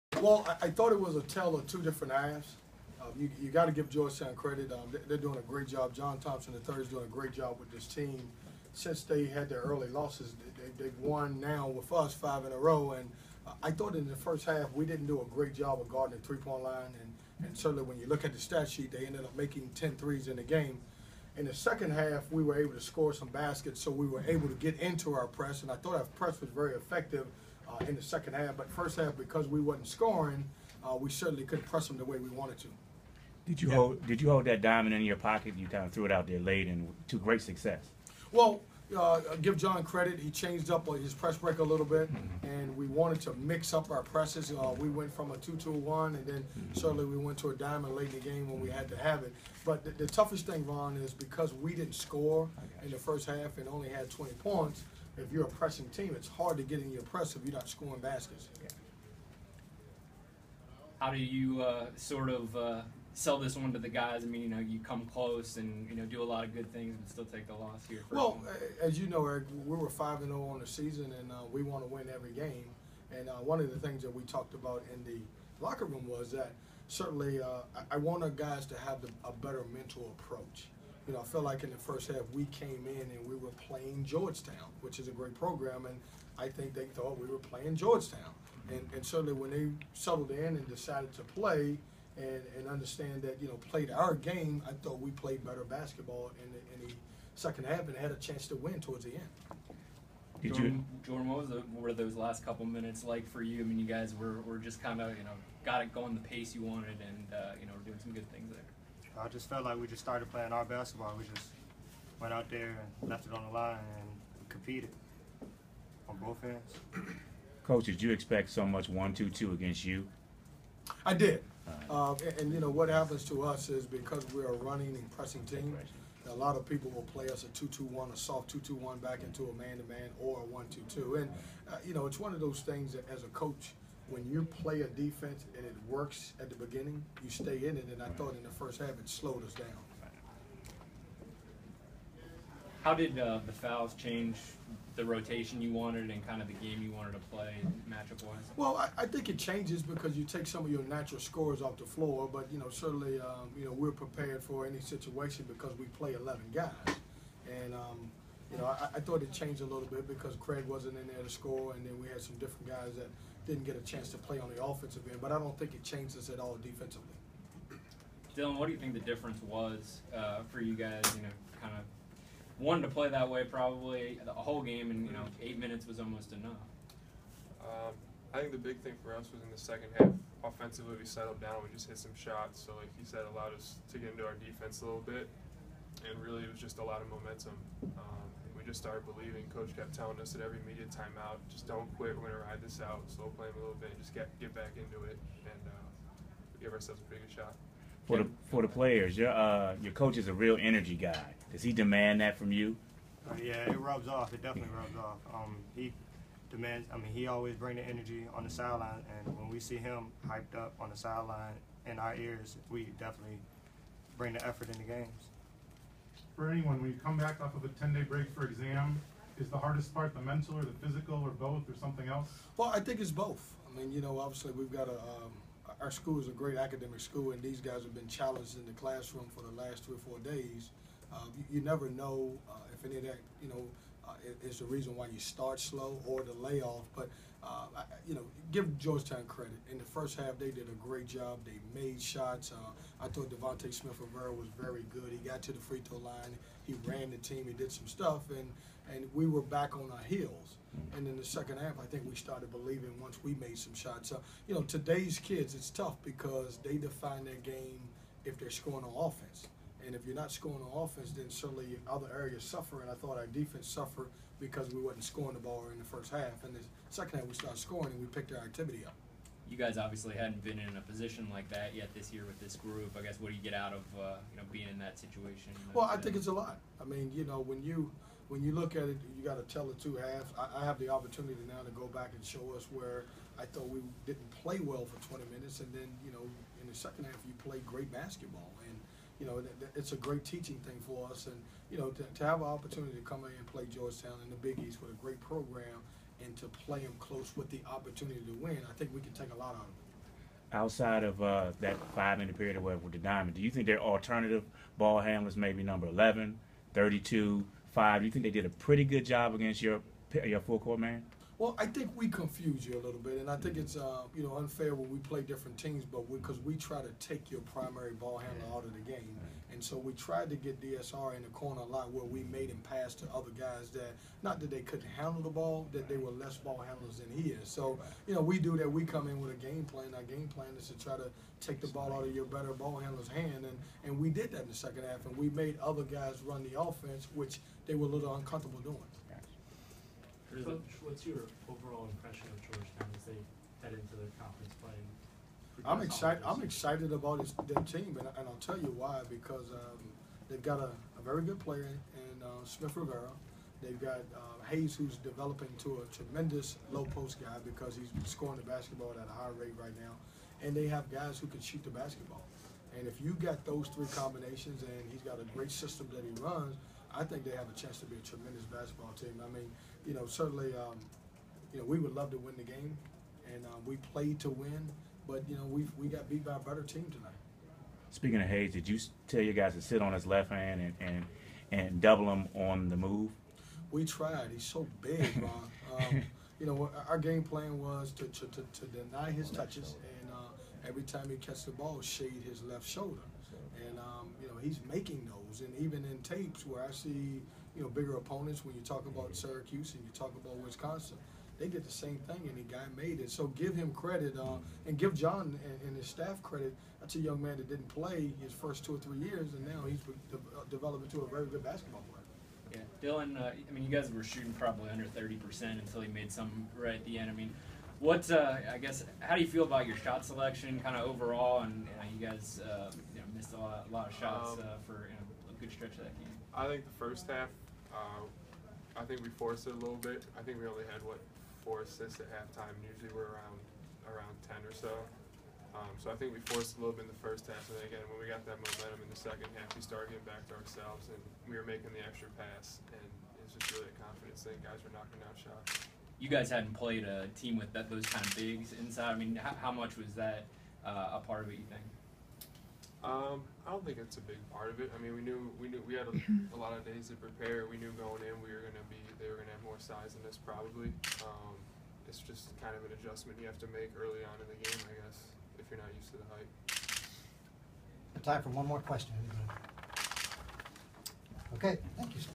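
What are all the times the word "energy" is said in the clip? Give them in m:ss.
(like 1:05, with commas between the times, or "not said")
3:20, 3:27.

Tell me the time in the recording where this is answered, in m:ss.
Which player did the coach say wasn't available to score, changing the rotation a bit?
2:40.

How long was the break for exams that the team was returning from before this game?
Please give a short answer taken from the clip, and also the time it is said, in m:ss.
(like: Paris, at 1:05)
10 days, at 3:37.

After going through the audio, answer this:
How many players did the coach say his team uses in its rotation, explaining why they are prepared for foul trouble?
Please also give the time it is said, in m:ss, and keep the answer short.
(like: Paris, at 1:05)
11, at 2:36.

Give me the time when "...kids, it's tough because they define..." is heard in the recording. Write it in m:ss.
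4:15.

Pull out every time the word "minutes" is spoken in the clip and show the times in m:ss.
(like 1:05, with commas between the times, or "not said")
1:42, 2:55, 4:45, 5:02.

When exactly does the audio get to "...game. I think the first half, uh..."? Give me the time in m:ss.
7:05.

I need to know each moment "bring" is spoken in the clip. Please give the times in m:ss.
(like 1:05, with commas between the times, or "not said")
3:27, 3:34.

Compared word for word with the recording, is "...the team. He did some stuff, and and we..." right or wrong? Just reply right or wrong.
right.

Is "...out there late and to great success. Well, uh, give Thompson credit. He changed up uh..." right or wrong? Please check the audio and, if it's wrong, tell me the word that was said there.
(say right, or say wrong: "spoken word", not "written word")
wrong: "John", not "Thompson".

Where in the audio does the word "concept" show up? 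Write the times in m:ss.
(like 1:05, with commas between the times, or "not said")
not said.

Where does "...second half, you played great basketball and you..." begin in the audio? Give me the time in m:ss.
4:46.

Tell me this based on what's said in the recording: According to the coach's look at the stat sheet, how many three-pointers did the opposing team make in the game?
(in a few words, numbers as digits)
10.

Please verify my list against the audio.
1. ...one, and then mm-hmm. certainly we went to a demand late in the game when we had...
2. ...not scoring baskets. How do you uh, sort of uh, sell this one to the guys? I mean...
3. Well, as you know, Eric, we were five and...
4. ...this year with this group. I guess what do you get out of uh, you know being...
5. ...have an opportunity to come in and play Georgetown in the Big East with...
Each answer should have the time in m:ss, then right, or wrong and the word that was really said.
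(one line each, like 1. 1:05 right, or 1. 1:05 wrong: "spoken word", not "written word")
1. 0:45 wrong: "diamond", not "demand"
2. 0:57 right
3. 1:08 right
4. 4:31 right
5. 4:52 right.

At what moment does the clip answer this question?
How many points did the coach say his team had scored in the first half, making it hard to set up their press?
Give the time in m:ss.
0:54.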